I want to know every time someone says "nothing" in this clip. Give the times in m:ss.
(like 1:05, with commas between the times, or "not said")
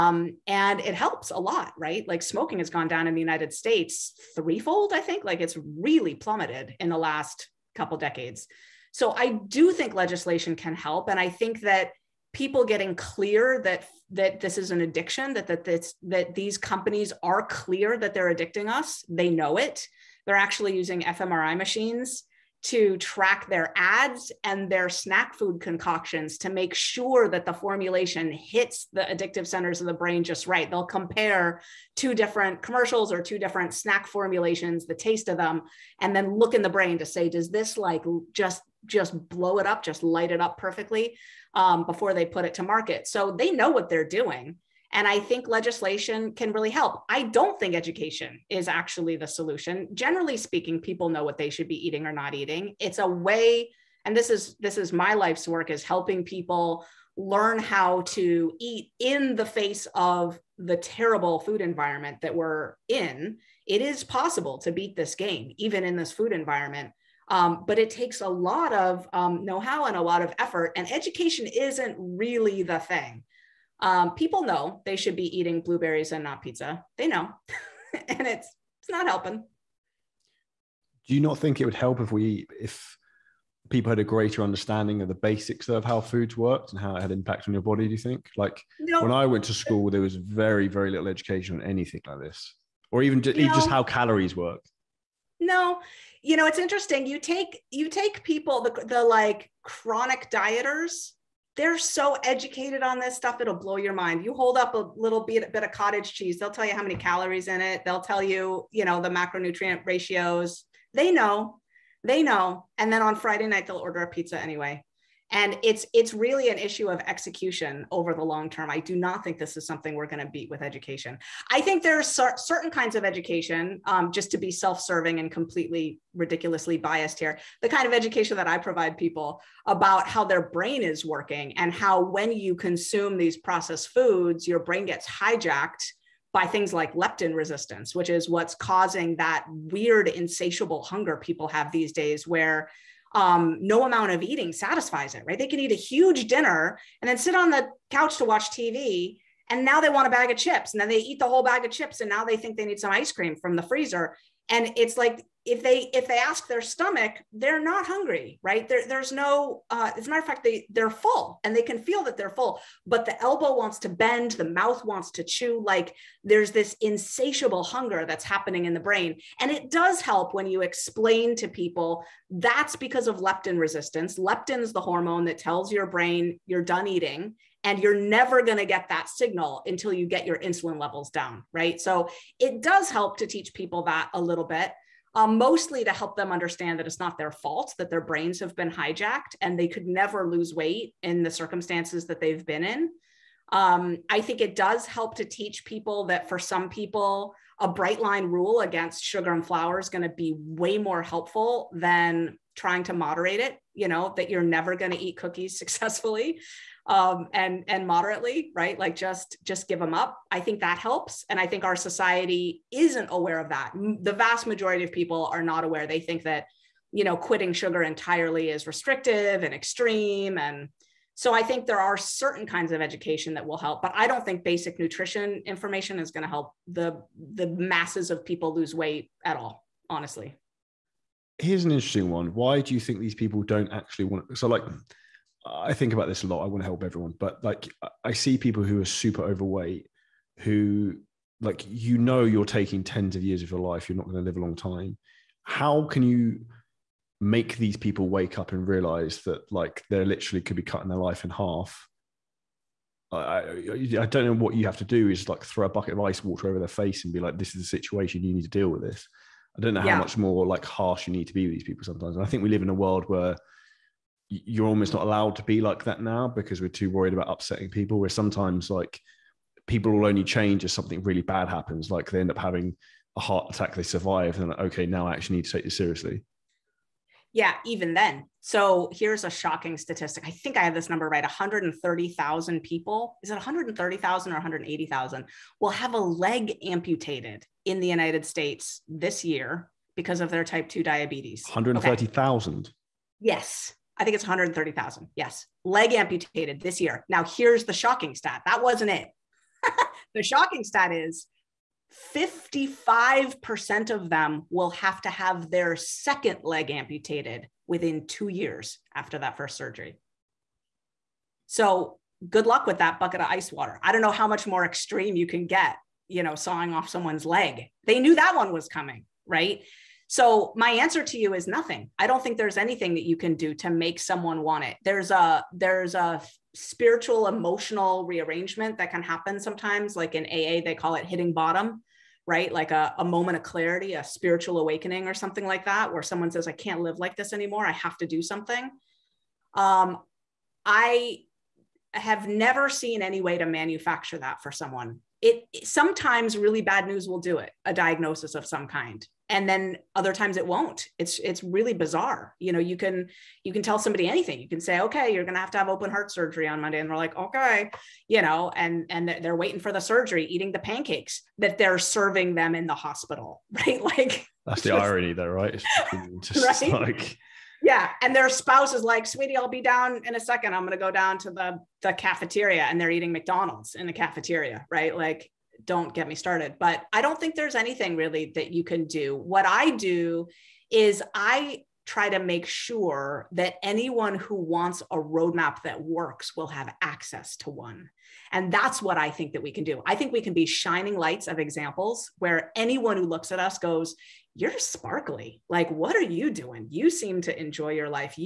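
5:21.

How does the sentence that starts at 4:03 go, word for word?
You're not going to live a long time.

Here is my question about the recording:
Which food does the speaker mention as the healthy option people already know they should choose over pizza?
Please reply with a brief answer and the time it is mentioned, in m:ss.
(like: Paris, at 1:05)
blueberries, at 1:15.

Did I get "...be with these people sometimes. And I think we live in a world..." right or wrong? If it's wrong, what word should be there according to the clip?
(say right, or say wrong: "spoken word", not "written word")
right.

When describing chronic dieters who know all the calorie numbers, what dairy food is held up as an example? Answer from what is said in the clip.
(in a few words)
cottage cheese.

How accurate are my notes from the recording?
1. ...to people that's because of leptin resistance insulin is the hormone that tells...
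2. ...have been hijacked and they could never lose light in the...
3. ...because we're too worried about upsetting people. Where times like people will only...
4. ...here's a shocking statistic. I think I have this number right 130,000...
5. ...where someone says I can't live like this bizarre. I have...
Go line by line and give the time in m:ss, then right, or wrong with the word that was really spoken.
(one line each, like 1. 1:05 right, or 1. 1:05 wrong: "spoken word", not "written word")
1. 2:51 wrong: "leptin", not "insulin"
2. 3:08 wrong: "weight", not "light"
3. 4:26 wrong: "sometimes", not "times"
4. 4:38 right
5. 5:35 wrong: "anymore", not "bizarre".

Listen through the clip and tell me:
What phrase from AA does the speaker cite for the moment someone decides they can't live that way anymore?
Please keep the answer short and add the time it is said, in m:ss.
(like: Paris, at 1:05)
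hitting bottom, at 5:31.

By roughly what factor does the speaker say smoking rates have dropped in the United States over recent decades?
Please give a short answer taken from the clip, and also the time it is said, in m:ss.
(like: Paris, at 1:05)
threefold, at 0:04.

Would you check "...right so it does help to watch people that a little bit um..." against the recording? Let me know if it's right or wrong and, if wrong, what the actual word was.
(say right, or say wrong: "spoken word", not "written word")
wrong: "teach", not "watch".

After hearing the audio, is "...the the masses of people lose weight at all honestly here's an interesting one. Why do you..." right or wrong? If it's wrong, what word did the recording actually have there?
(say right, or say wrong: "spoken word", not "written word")
right.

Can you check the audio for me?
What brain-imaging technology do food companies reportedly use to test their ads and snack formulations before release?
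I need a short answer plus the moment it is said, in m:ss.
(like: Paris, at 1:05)
fMRI machines, at 0:20.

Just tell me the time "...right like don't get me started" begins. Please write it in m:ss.
6:14.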